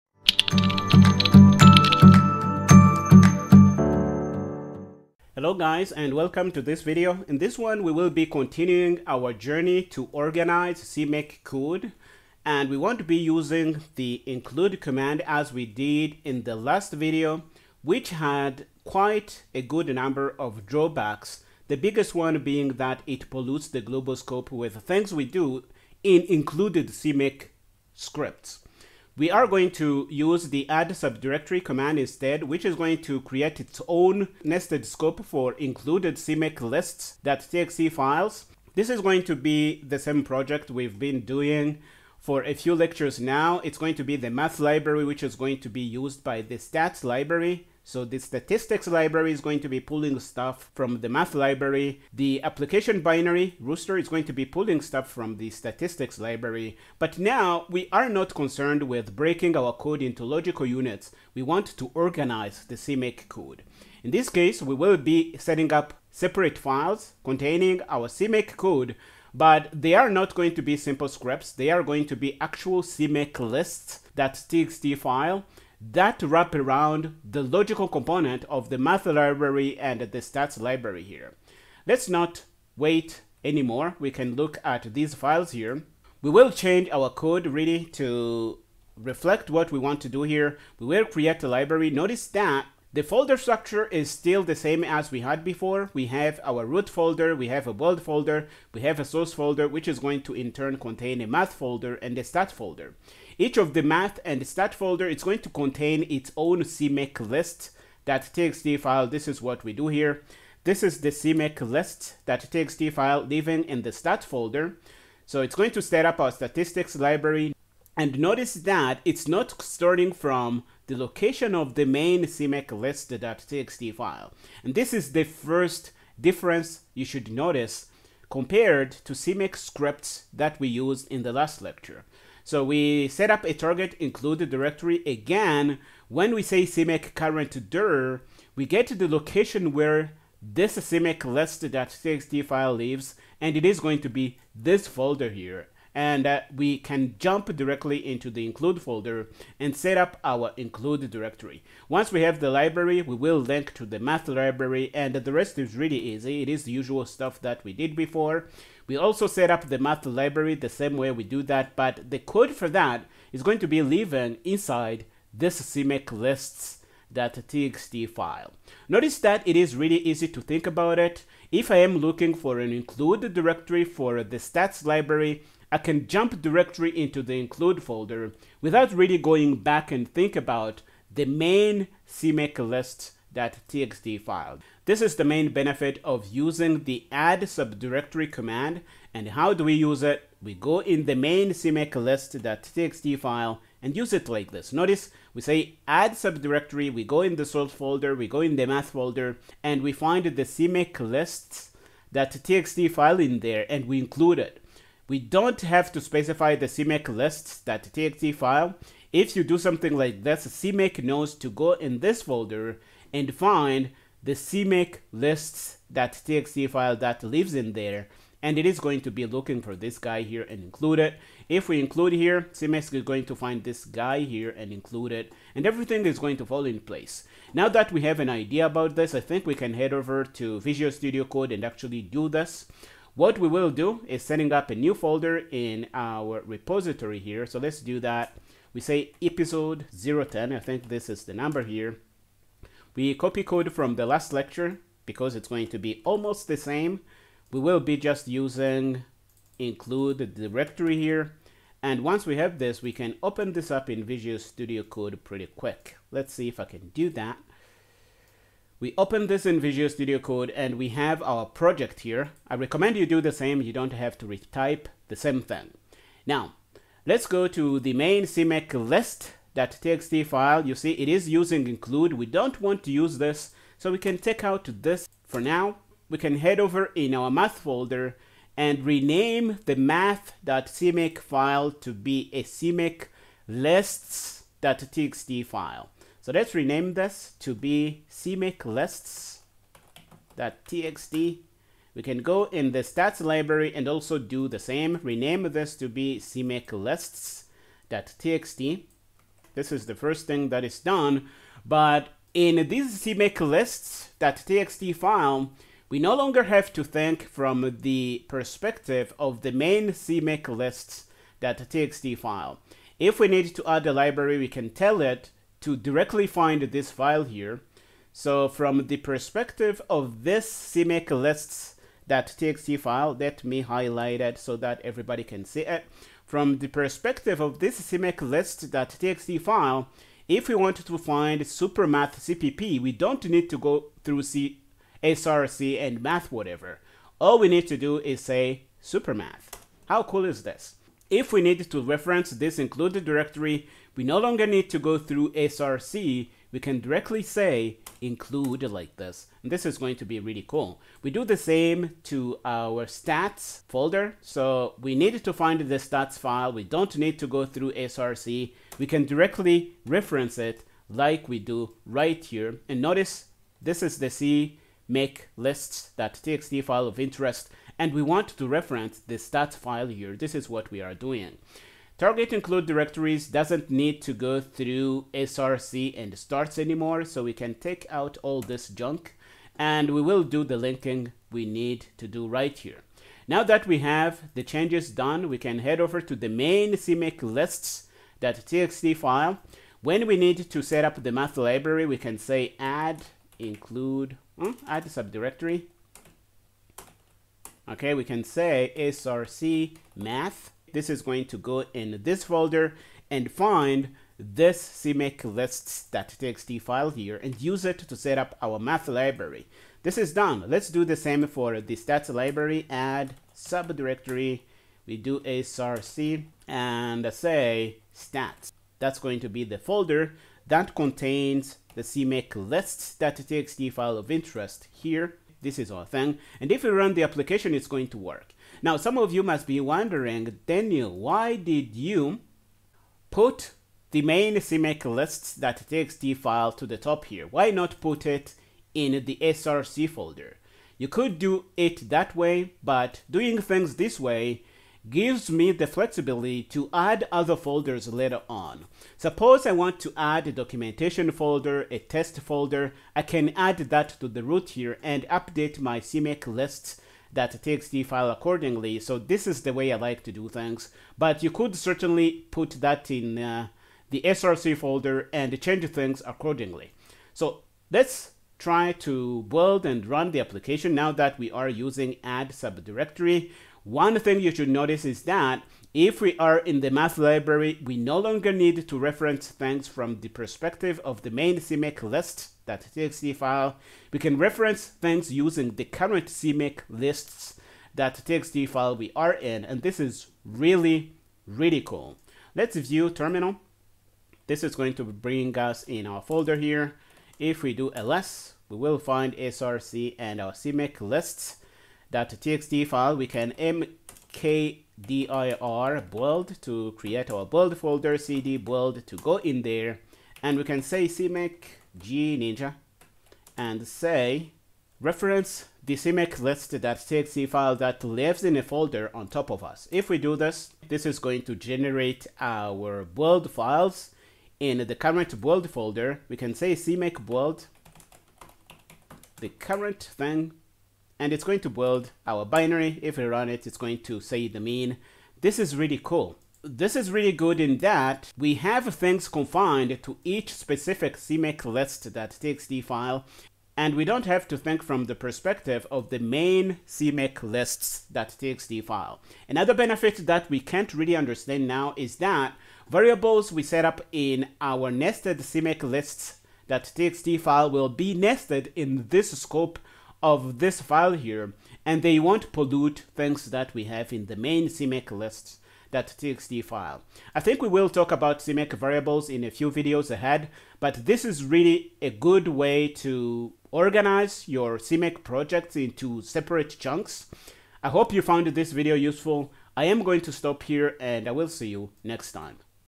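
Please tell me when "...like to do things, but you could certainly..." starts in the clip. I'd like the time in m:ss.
7:39.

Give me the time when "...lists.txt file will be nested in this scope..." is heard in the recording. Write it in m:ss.
9:15.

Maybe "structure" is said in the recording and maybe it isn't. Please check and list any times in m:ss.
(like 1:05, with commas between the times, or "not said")
1:33.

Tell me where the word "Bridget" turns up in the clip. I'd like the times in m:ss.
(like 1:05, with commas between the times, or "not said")
not said.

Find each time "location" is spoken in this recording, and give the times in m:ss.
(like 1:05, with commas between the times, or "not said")
2:00, 2:19.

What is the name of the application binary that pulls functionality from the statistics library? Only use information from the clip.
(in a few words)
rooster.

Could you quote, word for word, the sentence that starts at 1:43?
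Each of the math and stat folder is going to contain its own CMake list that txt file.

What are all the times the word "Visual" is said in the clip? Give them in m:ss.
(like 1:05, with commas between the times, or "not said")
3:50, 4:14, 4:19.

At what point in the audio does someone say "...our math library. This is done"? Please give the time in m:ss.
6:48.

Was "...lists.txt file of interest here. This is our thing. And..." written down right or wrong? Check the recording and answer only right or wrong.
right.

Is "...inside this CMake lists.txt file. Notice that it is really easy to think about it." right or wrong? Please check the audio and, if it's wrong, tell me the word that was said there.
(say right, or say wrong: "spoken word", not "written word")
right.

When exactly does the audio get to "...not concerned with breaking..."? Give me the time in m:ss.
0:58.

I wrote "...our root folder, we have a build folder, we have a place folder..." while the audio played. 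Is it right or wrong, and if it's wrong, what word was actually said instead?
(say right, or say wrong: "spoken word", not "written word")
wrong: "source", not "place".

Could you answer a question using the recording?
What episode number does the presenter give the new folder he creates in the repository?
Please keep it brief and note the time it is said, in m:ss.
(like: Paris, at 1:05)
010, at 4:00.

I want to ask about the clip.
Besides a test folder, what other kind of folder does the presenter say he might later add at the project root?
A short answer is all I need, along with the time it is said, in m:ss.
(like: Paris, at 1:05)
documentation folder, at 7:30.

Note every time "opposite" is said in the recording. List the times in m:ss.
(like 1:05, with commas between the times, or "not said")
not said.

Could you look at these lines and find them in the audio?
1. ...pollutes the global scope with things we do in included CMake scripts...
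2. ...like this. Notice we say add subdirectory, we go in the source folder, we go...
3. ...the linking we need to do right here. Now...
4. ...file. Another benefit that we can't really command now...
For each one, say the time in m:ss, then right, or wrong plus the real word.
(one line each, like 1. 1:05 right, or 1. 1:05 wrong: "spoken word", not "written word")
1. 0:23 right
2. 3:14 right
3. 6:20 right
4. 9:08 wrong: "understand", not "command".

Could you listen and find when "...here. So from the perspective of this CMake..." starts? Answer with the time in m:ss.
5:17.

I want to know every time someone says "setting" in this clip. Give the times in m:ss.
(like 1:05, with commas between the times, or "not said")
1:05, 3:54.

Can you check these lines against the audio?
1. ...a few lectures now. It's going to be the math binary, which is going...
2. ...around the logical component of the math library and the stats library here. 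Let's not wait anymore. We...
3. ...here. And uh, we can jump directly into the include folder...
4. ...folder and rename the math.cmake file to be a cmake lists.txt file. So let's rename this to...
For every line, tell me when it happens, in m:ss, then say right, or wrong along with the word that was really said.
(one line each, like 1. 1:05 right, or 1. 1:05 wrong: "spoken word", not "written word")
1. 0:42 wrong: "library", not "binary"
2. 1:16 right
3. 2:25 right
4. 4:37 right.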